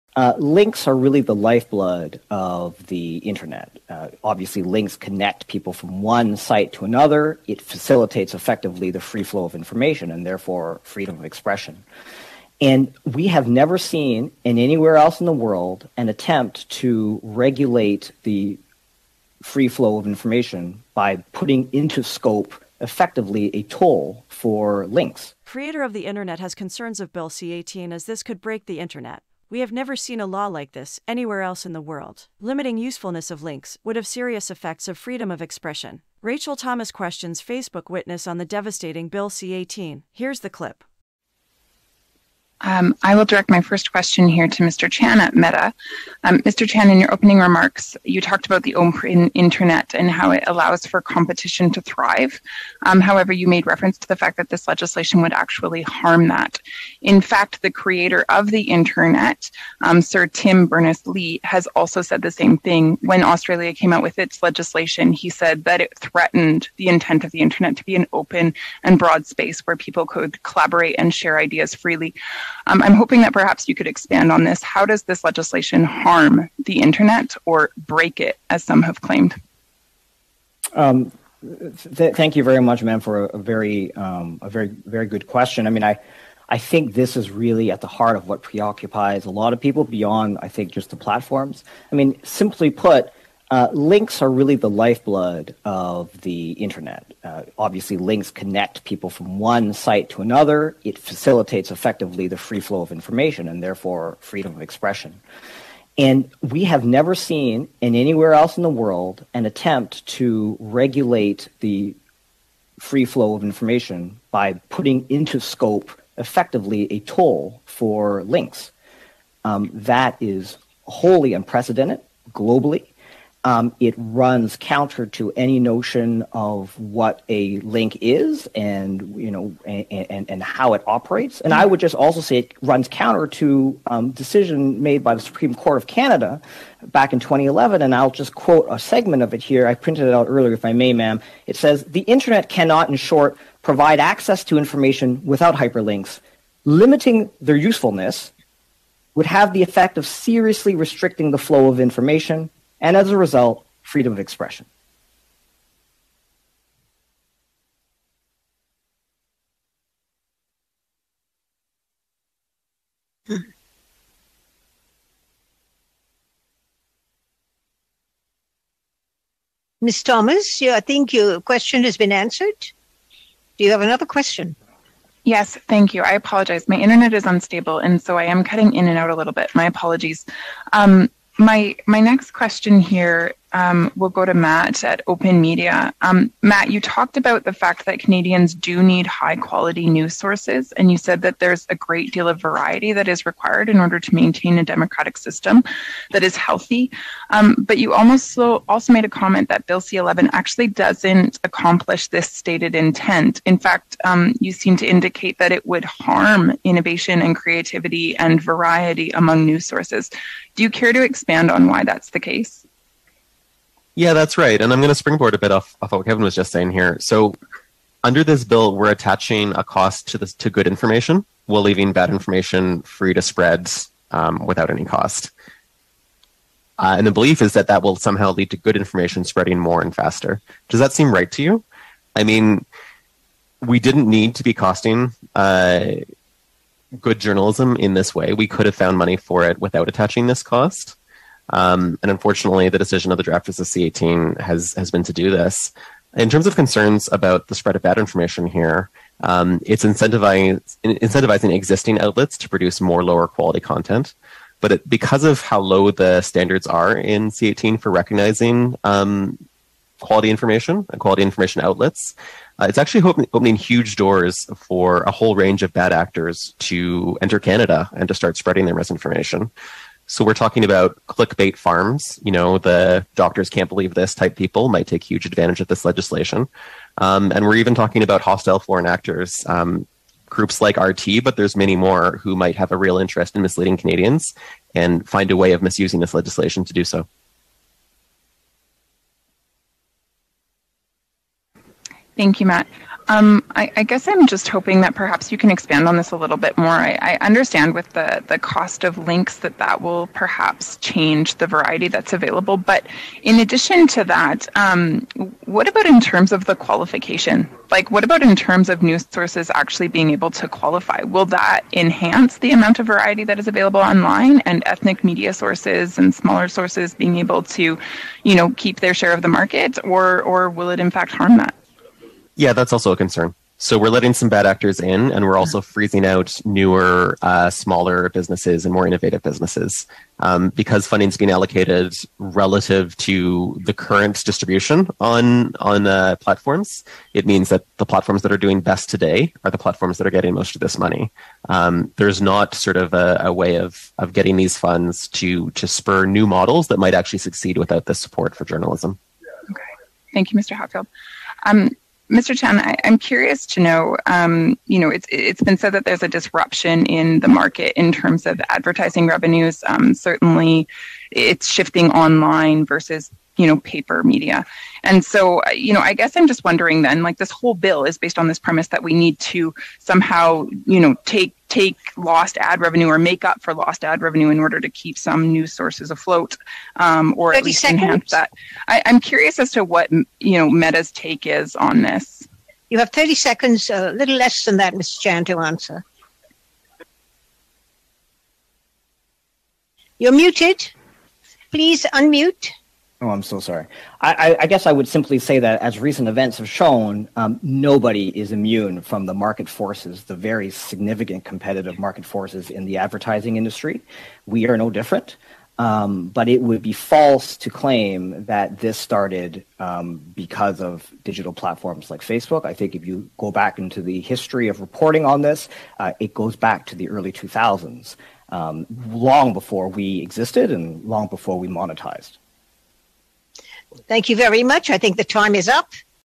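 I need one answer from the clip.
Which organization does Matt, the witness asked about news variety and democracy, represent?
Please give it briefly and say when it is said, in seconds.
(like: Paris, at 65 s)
OpenMedia, at 185 s.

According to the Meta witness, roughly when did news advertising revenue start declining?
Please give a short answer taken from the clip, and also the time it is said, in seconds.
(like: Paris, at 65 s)
early 2000s, at 416 s.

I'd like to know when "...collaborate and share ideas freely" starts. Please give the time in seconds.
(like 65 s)
70 s.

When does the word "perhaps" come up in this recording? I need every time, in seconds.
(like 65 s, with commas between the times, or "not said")
73 s, 294 s, 300 s.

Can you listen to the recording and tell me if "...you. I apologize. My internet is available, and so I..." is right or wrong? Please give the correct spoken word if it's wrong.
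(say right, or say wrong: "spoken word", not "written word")
wrong: "unstable", not "available".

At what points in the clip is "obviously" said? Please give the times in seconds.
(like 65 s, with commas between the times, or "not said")
4 s, 97 s.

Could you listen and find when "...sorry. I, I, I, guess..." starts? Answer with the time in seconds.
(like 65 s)
393 s.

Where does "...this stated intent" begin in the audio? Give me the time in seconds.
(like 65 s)
202 s.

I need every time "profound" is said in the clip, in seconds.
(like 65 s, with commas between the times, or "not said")
not said.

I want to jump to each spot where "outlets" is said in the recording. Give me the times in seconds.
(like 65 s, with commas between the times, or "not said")
251 s, 261 s.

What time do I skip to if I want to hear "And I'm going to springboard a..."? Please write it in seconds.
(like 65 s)
214 s.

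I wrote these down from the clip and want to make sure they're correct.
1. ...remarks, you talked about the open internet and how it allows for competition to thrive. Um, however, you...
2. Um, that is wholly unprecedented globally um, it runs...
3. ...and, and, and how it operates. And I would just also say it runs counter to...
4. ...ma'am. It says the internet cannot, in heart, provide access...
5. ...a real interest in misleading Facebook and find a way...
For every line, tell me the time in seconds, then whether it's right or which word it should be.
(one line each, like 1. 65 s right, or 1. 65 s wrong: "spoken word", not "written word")
1. 47 s right
2. 119 s right
3. 129 s right
4. 140 s wrong: "short", not "heart"
5. 282 s wrong: "Canadians", not "Facebook".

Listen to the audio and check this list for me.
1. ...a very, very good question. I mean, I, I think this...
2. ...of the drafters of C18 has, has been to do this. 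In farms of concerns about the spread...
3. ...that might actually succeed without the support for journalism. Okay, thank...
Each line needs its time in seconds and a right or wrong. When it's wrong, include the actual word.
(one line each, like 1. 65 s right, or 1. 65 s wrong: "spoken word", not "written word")
1. 84 s right
2. 243 s wrong: "terms", not "farms"
3. 346 s right.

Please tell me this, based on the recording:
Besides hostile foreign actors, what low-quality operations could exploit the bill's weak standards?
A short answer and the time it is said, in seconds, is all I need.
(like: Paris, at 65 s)
clickbait farms, at 271 s.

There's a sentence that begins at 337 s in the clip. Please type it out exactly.
It means that the platforms that are doing best today are the platforms that are getting most of this money.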